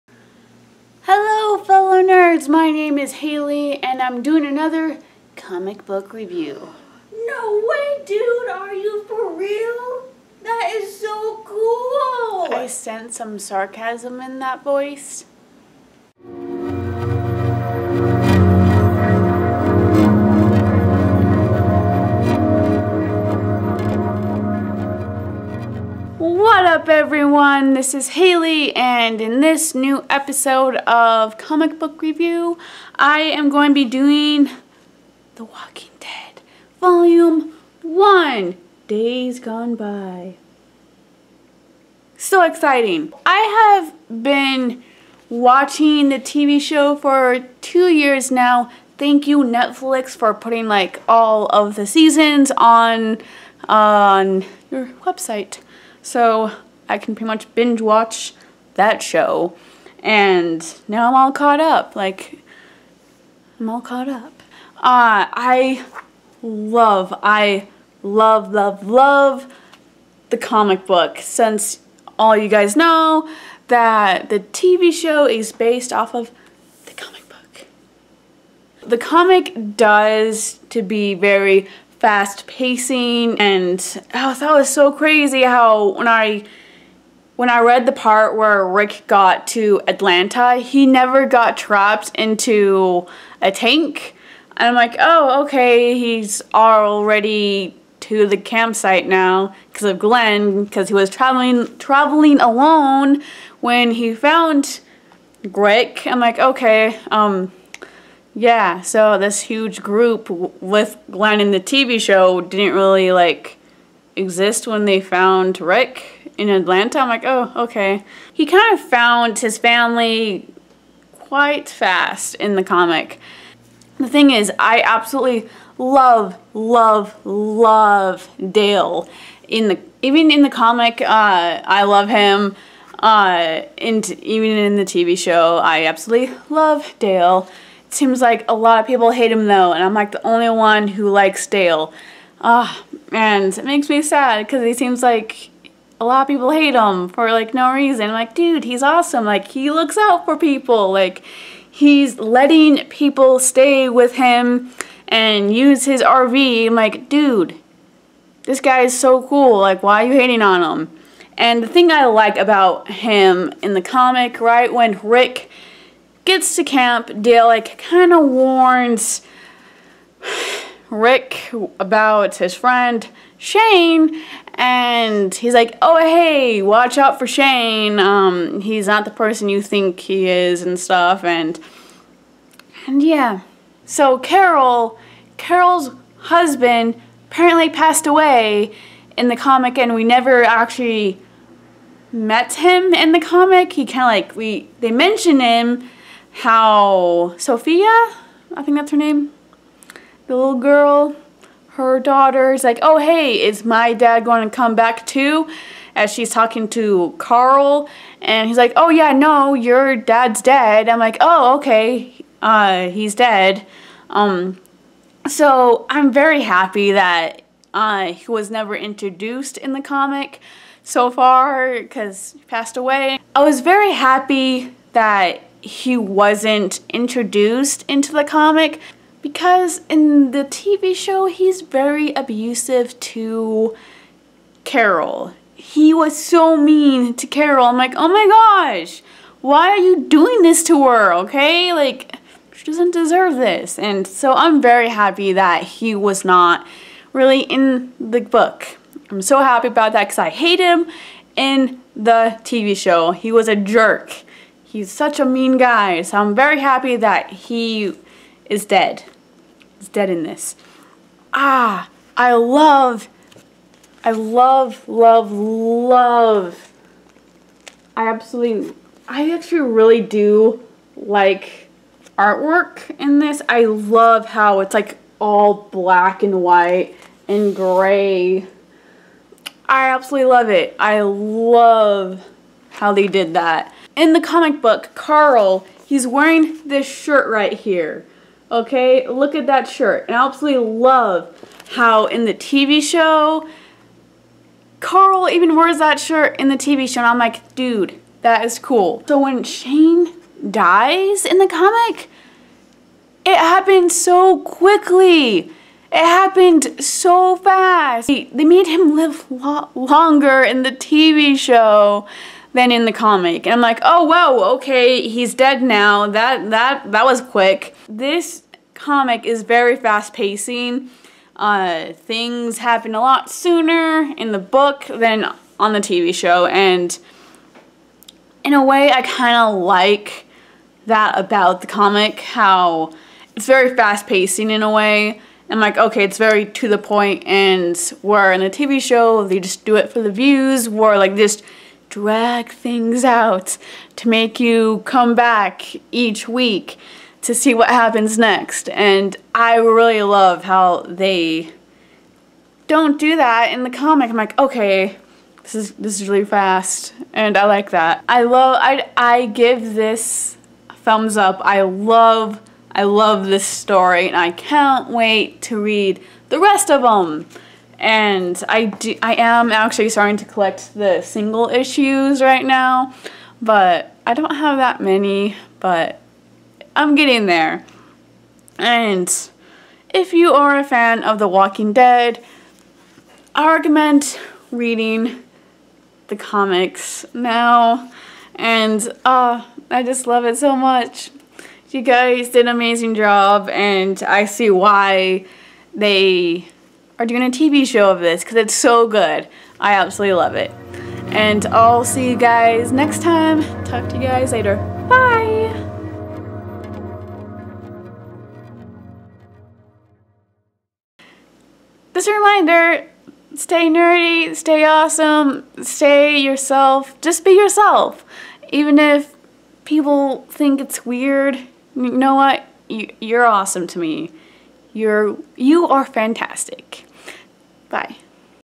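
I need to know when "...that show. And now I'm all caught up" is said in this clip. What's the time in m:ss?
0:58.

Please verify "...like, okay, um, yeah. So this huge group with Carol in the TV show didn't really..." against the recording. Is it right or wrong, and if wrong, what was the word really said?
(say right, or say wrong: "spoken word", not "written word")
wrong: "Glenn", not "Carol".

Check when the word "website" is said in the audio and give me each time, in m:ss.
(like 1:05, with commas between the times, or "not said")
0:55.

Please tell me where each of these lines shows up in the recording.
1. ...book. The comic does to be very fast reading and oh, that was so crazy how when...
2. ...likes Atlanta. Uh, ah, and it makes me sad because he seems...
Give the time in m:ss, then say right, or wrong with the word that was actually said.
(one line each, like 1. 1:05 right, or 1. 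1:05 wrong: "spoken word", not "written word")
1. 1:17 wrong: "pacing", not "reading"
2. 2:21 wrong: "Dale", not "Atlanta".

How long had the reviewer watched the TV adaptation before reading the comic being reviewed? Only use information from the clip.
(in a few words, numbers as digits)
2 years.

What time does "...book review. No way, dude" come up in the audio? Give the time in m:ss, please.
0:05.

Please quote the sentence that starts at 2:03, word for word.
The thing is, I absolutely love, love, love Dale.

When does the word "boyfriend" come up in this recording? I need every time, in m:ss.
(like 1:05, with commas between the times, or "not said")
not said.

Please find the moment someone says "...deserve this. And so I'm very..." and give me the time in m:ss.
4:02.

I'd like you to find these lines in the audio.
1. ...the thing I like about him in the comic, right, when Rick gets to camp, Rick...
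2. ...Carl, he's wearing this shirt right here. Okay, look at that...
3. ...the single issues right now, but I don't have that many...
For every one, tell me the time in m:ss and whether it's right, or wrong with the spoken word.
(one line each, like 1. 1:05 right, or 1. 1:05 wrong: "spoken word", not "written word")
1. 2:41 wrong: "Dale", not "Rick"
2. 4:44 right
3. 6:10 right.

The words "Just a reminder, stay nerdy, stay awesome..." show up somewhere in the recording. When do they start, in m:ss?
6:51.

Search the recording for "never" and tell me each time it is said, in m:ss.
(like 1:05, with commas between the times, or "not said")
1:30, 3:10, 3:38.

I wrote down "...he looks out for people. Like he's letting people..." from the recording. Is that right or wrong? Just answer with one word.
right.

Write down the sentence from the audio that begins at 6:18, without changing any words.
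And if you are a fan of The Walking Dead, I recommend reading the comics now.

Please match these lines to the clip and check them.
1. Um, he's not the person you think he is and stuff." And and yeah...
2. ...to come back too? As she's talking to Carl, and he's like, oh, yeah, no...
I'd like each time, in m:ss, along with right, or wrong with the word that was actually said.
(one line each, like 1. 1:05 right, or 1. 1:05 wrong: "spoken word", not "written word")
1. 2:57 right
2. 3:24 right.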